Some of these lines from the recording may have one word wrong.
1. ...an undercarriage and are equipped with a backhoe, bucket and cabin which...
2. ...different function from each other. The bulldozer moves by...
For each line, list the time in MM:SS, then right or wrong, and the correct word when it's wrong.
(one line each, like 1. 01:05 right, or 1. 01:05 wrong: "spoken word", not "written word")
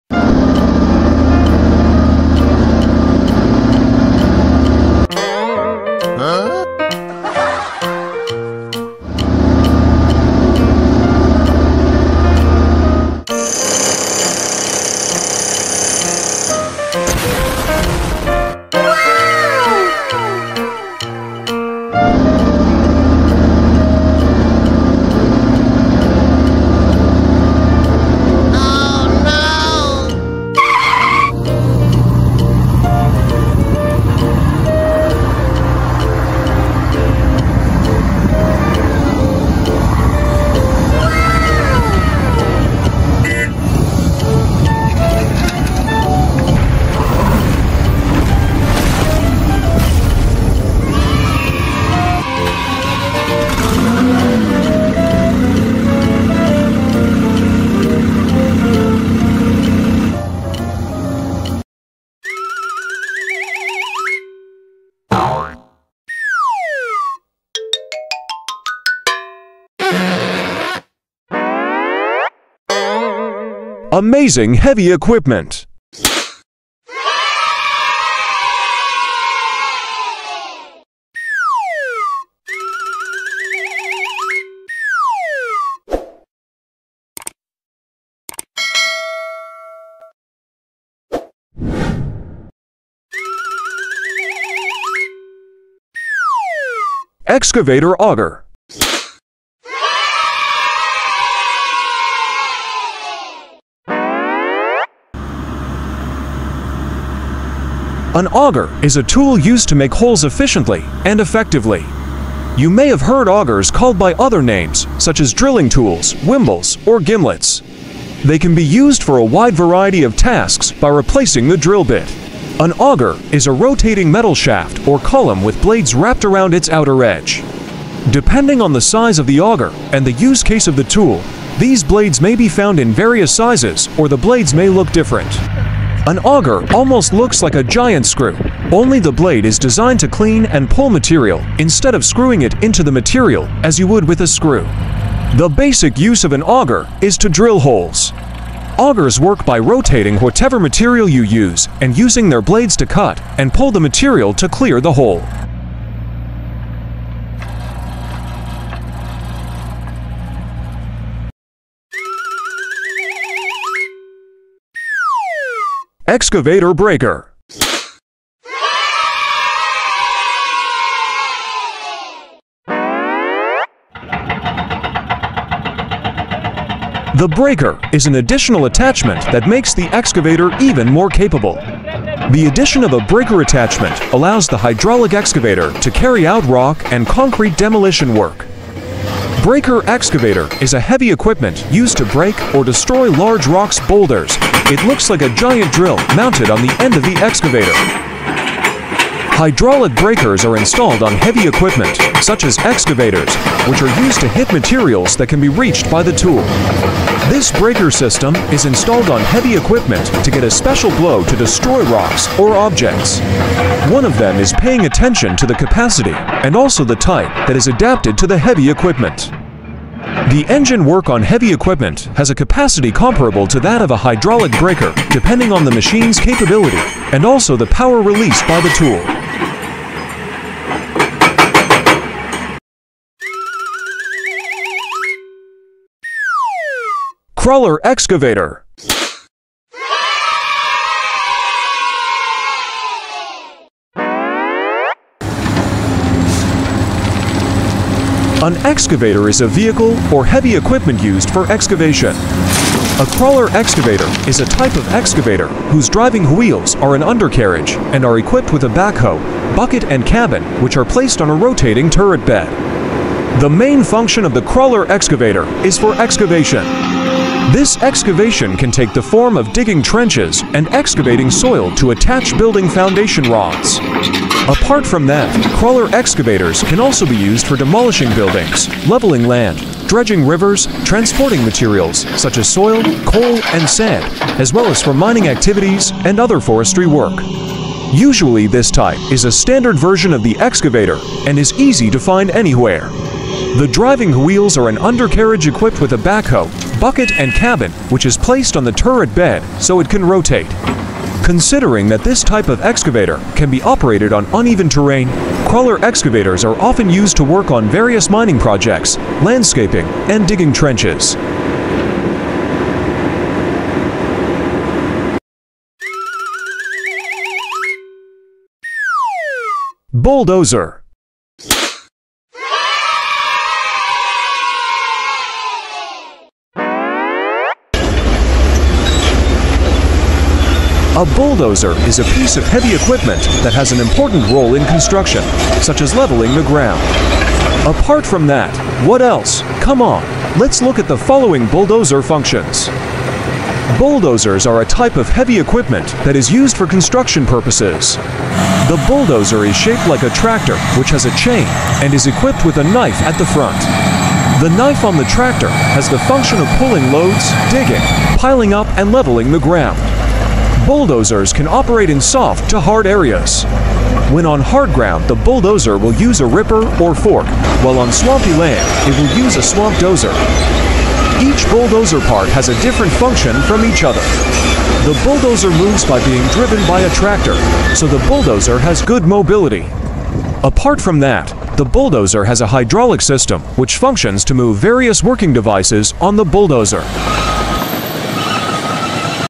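1. 04:16 right
2. 06:12 right.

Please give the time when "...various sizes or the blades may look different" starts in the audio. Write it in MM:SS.
02:12.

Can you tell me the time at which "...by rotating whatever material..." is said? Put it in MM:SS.
02:29.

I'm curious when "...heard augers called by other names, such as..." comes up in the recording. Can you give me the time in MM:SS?
01:52.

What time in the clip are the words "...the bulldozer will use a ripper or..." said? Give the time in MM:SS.
06:05.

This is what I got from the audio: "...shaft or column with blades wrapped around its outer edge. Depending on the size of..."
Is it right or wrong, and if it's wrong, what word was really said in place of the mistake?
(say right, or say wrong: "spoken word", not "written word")
right.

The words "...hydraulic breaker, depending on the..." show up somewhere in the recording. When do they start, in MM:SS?
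03:43.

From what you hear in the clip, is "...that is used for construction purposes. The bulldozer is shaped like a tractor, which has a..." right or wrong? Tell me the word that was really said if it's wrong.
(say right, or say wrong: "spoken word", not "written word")
right.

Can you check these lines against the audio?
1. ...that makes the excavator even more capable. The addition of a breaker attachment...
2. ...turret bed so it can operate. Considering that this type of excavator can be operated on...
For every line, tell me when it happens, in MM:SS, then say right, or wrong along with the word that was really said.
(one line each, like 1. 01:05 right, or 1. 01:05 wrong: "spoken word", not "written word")
1. 02:59 right
2. 04:58 wrong: "rotate", not "operate".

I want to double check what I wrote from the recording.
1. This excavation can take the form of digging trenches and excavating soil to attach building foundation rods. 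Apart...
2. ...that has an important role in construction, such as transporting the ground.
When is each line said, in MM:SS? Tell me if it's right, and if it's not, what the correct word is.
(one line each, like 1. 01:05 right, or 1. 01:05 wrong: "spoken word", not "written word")
1. 04:27 right
2. 05:33 wrong: "leveling", not "transporting".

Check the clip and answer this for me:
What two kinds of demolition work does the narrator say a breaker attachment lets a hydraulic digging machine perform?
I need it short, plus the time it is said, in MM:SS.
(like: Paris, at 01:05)
rock and concrete, at 03:06.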